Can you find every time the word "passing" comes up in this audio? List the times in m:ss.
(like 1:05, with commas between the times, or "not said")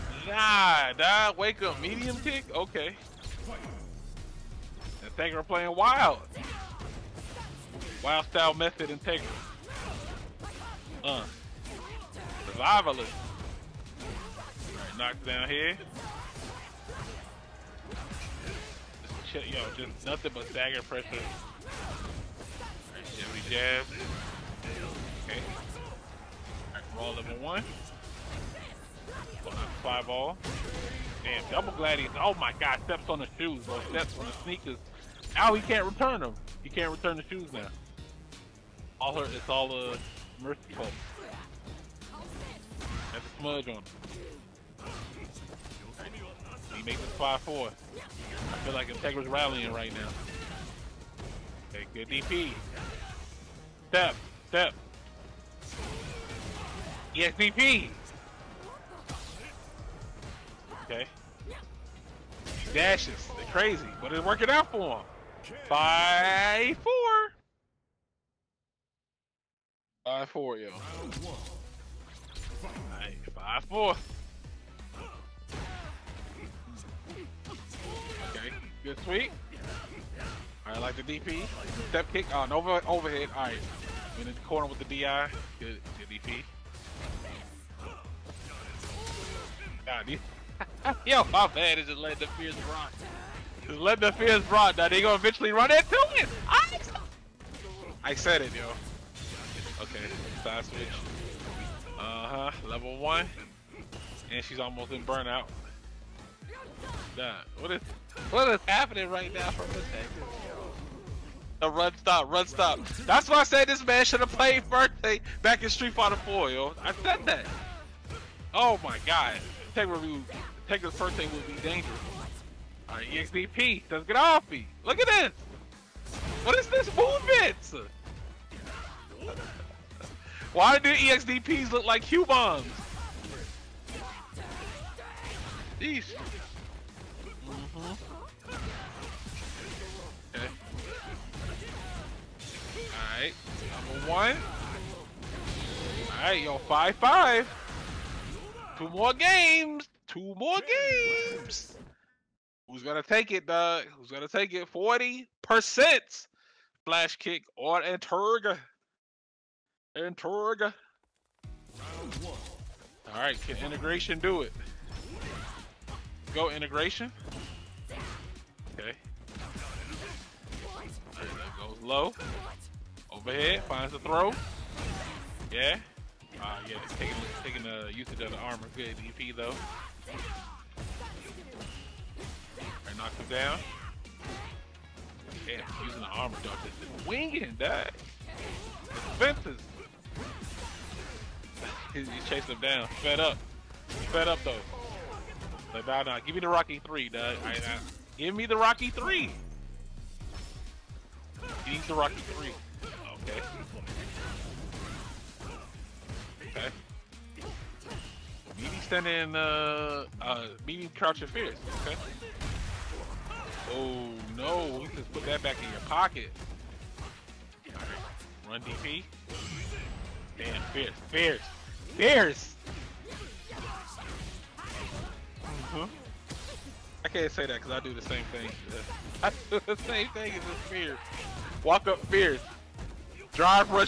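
not said.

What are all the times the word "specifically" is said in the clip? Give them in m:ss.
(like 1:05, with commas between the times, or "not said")
not said.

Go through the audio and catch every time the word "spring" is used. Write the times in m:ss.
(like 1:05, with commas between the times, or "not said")
not said.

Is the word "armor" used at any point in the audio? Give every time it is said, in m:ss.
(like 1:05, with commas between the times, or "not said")
2:58, 3:06.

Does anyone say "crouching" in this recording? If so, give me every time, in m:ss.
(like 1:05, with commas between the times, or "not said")
3:30.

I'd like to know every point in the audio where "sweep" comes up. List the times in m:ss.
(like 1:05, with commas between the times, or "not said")
1:19.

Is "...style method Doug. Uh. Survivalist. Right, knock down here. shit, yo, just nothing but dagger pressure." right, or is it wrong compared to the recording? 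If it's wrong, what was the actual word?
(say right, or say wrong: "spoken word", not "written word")
wrong: "Integra", not "Doug".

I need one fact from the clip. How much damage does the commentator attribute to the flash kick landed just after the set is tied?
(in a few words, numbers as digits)
40%.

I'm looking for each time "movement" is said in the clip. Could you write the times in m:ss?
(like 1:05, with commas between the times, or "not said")
2:06.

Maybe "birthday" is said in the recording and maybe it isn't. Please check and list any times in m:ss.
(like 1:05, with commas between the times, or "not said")
1:54, 2:00.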